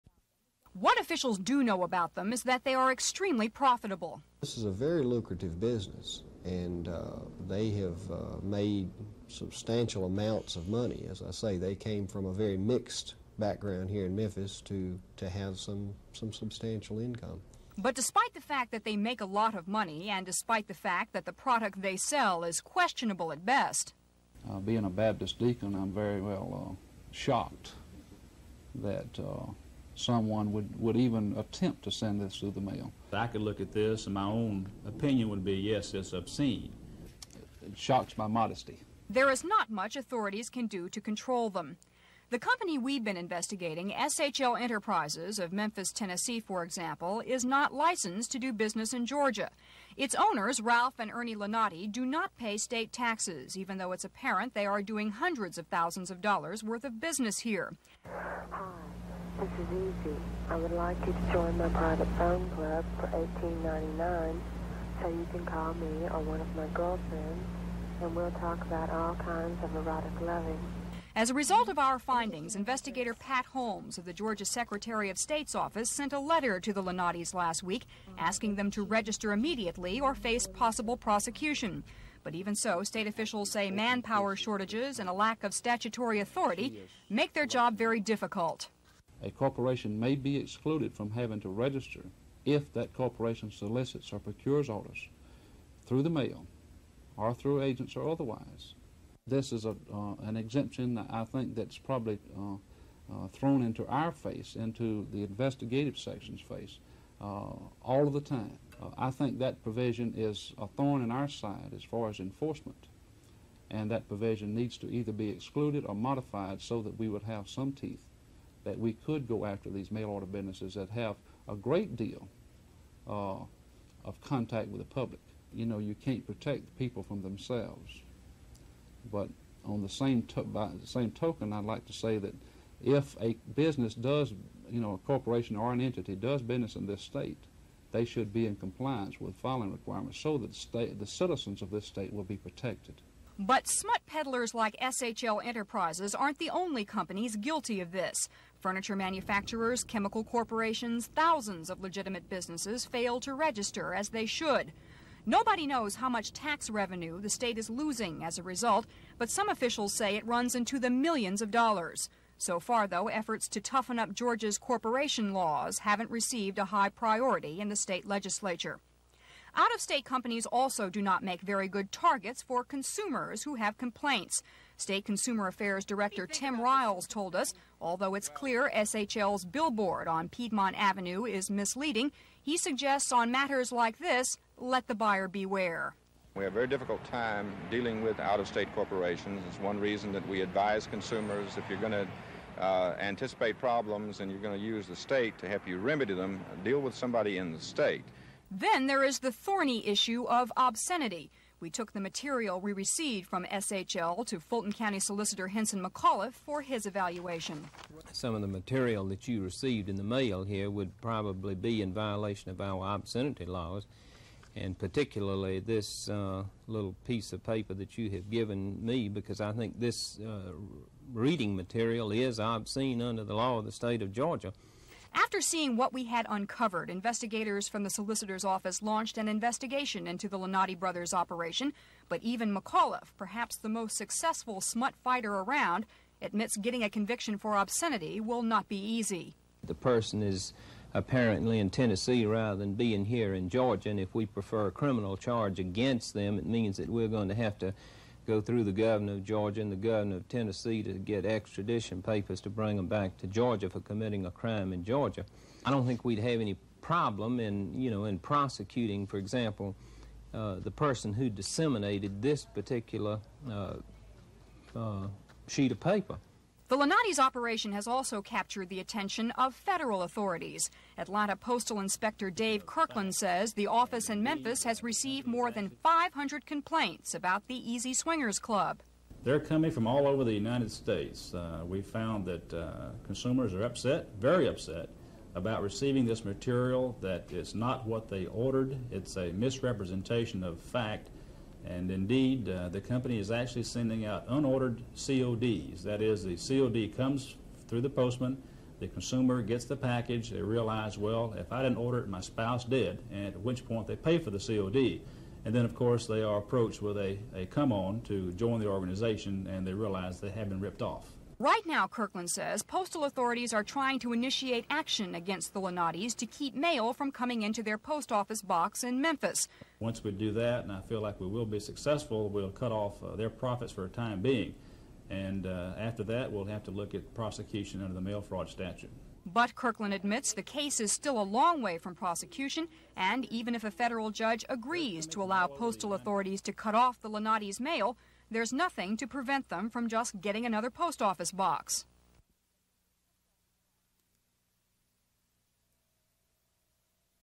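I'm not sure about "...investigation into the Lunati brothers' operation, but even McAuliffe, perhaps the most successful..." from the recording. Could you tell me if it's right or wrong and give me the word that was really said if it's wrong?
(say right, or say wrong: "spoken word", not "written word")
right.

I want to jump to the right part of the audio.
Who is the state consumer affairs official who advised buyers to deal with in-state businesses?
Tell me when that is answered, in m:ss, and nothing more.
2:56.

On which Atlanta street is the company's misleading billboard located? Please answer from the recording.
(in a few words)
Piedmont Avenue.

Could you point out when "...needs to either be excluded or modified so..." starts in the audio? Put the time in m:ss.
1:54.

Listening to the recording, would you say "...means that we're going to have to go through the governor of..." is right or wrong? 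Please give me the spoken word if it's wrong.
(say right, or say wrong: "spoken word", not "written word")
right.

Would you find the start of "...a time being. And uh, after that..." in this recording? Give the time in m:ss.
5:23.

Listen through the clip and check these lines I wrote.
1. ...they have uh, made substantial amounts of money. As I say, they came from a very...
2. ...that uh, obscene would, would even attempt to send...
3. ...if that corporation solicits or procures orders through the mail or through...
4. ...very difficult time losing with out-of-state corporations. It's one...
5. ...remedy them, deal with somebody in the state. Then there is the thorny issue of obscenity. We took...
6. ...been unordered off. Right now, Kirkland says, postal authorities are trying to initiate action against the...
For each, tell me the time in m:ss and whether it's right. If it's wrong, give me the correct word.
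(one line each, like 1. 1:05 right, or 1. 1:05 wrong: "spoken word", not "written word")
1. 0:07 right
2. 0:28 wrong: "someone", not "obscene"
3. 1:32 right
4. 3:06 wrong: "dealing", not "losing"
5. 3:15 right
6. 5:10 wrong: "ripped", not "unordered".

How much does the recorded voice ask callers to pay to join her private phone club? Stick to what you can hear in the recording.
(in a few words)
$18.99.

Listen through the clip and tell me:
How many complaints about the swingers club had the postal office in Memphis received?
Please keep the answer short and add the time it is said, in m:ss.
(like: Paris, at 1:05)
more than 500, at 4:35.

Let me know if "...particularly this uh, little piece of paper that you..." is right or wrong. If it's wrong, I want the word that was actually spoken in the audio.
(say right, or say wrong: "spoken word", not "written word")
right.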